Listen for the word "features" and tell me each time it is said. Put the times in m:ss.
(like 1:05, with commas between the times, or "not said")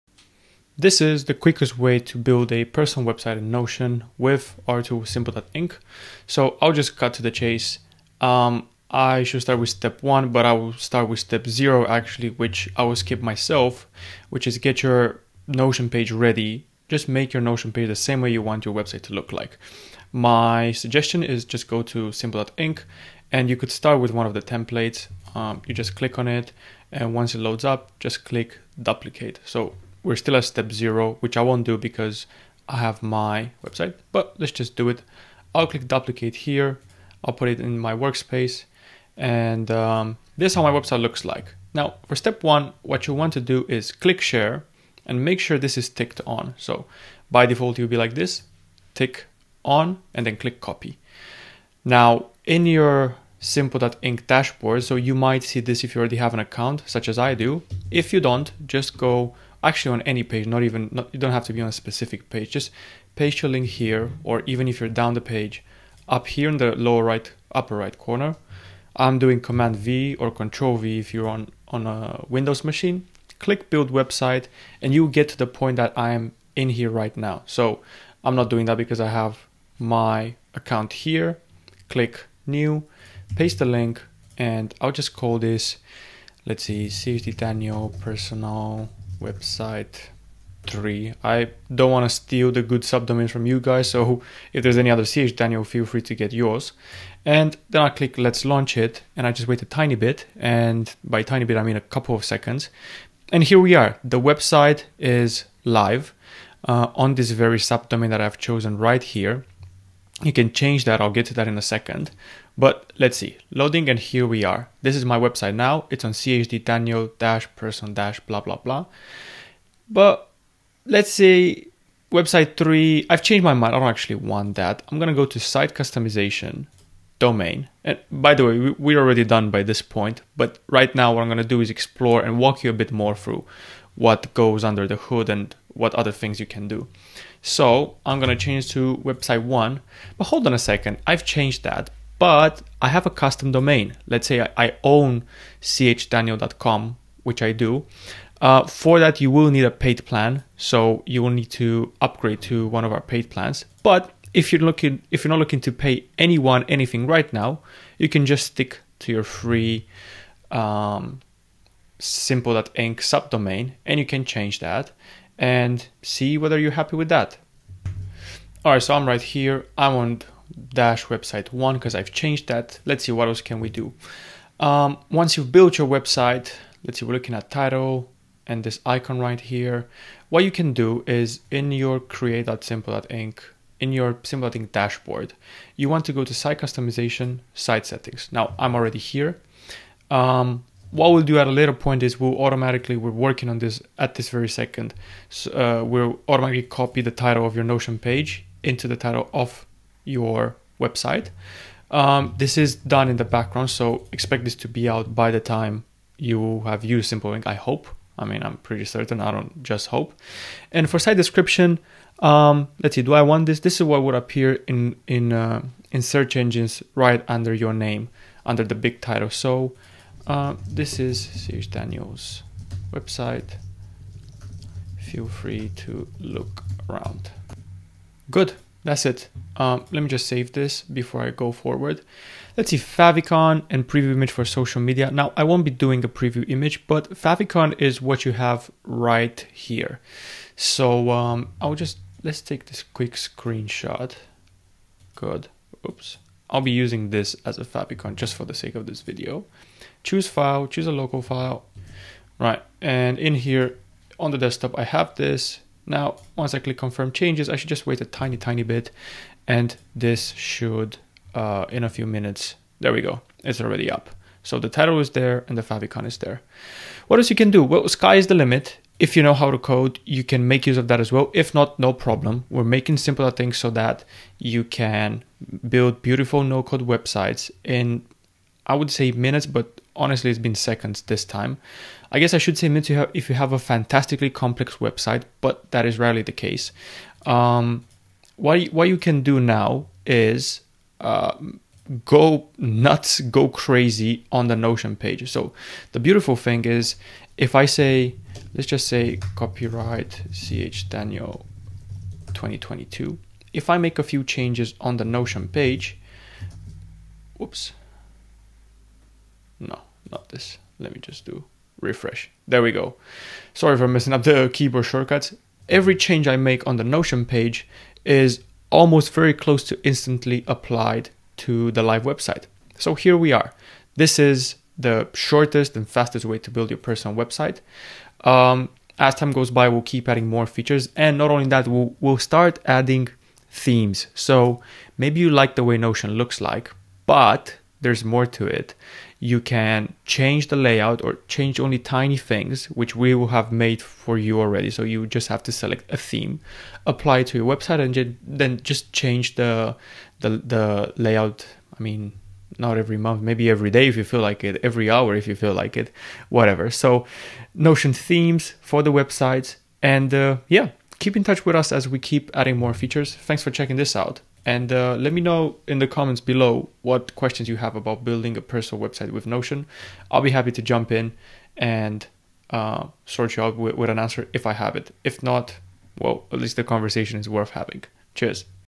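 5:30, 6:02.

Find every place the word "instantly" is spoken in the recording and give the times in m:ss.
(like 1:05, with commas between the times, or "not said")
5:19.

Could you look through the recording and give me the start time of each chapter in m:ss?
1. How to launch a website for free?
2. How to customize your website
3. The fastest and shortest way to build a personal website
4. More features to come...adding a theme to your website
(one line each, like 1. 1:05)
1. 0:55
2. 2:05
3. 4:56
4. 5:29.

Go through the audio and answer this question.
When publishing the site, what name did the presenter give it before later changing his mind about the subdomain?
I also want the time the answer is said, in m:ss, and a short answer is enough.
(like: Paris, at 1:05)
CH Daniel personal website three, at 1:26.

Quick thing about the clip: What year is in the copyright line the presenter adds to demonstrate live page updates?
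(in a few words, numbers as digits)
2022.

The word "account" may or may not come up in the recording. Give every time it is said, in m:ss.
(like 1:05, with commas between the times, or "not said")
0:56, 1:20.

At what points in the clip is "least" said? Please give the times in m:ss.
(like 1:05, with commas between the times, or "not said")
6:16.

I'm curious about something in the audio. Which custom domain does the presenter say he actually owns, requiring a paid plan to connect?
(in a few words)
chdaniel.com.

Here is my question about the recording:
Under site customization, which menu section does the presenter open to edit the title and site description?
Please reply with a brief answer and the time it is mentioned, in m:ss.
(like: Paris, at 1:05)
site settings, at 3:07.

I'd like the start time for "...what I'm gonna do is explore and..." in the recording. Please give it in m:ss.
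2:11.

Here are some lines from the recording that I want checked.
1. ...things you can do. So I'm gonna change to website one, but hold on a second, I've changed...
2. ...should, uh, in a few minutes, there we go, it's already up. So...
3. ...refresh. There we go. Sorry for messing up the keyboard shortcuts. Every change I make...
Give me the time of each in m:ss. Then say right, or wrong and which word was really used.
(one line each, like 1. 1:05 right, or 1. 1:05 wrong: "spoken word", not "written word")
1. 2:16 right
2. 4:20 right
3. 5:11 right.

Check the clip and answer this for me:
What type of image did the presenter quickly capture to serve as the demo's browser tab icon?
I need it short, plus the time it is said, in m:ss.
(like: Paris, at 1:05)
screenshot, at 4:03.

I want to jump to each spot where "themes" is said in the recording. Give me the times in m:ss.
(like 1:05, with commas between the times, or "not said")
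5:33, 5:45, 5:57.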